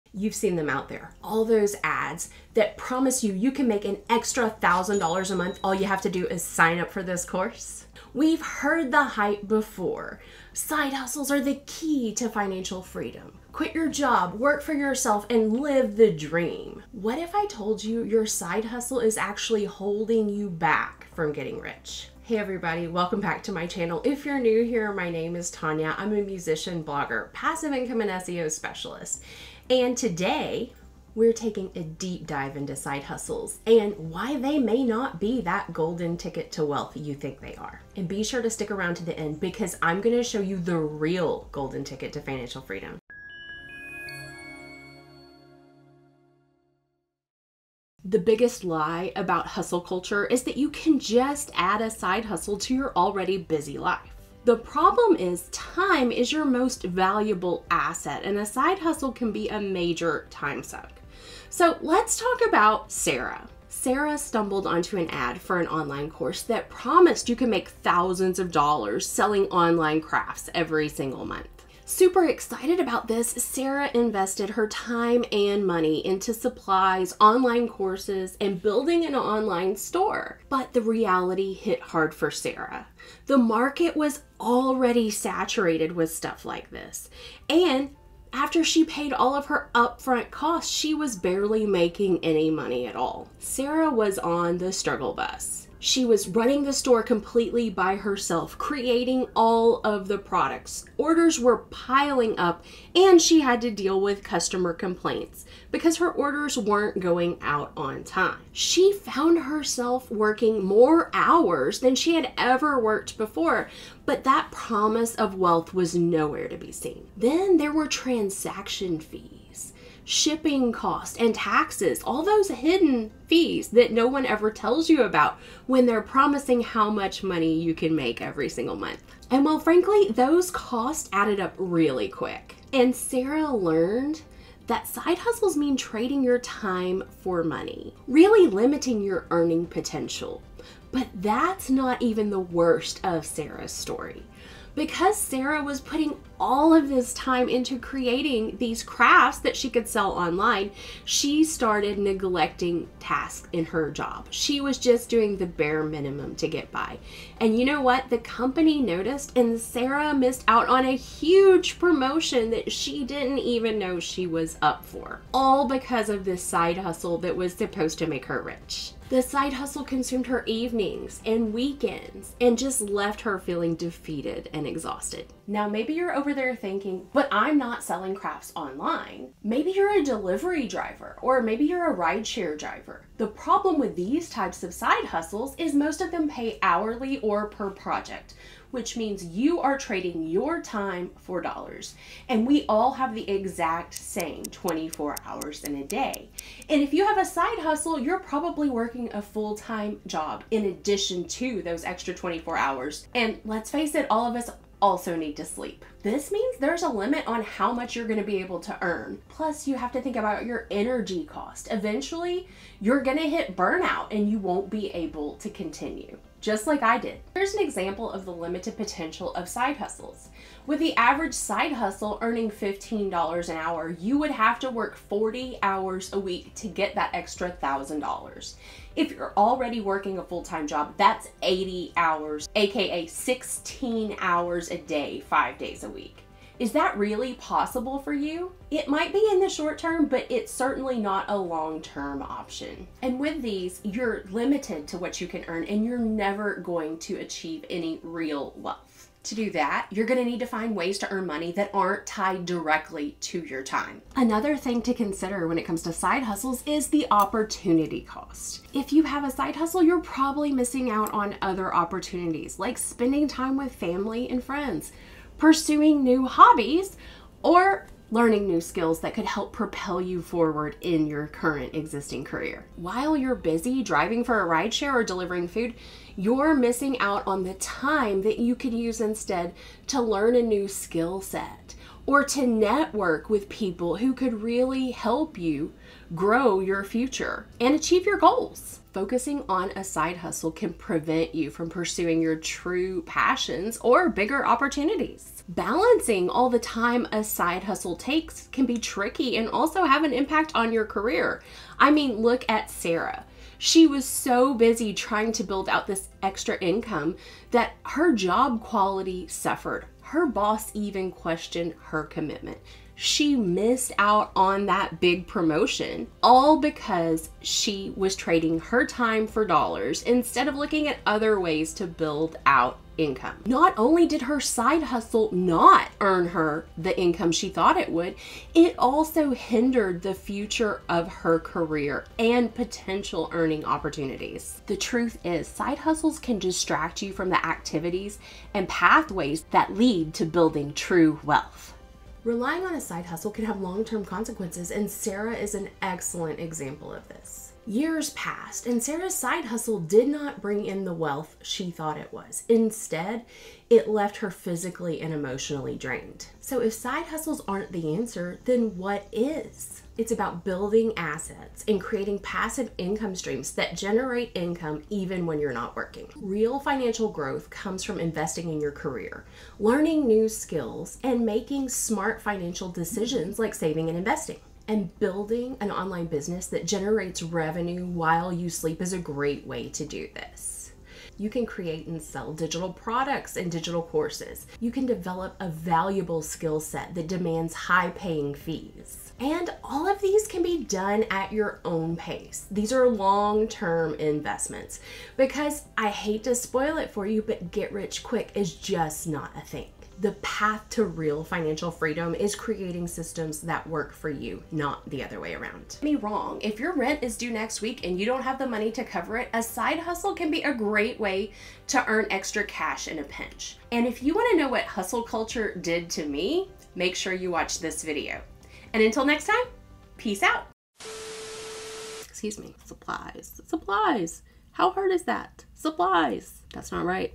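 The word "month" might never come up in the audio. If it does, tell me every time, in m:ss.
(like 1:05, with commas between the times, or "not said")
0:05, 1:11, 2:08.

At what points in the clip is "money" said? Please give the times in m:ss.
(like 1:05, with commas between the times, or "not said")
1:15, 1:32, 2:07, 2:17, 4:11, 6:48.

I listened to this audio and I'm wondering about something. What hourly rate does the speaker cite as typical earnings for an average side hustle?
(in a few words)
$15.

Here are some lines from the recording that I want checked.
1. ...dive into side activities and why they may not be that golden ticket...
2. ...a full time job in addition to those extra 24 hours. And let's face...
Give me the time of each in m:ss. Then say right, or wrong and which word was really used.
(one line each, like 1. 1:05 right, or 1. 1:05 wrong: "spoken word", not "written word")
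1. 0:32 wrong: "hustles", not "activities"
2. 3:19 right.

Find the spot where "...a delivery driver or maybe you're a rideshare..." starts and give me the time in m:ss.
2:59.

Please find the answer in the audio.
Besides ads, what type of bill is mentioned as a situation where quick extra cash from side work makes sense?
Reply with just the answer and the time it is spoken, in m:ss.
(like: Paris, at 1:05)
rent, at 6:46.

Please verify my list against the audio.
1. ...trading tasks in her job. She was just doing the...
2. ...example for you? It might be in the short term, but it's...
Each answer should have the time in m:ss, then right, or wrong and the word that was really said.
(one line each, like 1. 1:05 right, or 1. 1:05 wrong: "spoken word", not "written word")
1. 2:31 wrong: "neglecting", not "trading"
2. 3:57 wrong: "possible", not "example".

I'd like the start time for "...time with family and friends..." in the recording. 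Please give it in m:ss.
4:23.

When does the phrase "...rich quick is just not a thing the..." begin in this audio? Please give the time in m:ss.
6:37.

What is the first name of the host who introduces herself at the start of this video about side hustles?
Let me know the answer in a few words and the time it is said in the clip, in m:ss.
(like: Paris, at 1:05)
Tonya, at 0:25.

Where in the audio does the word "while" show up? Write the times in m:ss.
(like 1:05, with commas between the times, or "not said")
4:32, 6:17.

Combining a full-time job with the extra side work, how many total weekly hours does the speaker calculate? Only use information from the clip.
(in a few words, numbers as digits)
80.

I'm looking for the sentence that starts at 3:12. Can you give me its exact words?
And we all have the exact same 24 hours in a day.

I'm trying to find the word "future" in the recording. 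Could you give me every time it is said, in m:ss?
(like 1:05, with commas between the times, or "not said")
4:46, 5:30.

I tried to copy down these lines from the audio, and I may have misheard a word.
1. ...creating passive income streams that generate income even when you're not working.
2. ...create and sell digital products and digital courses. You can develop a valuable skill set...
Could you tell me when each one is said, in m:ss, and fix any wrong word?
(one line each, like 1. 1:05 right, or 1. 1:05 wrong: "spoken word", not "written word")
1. 6:01 right
2. 6:21 right.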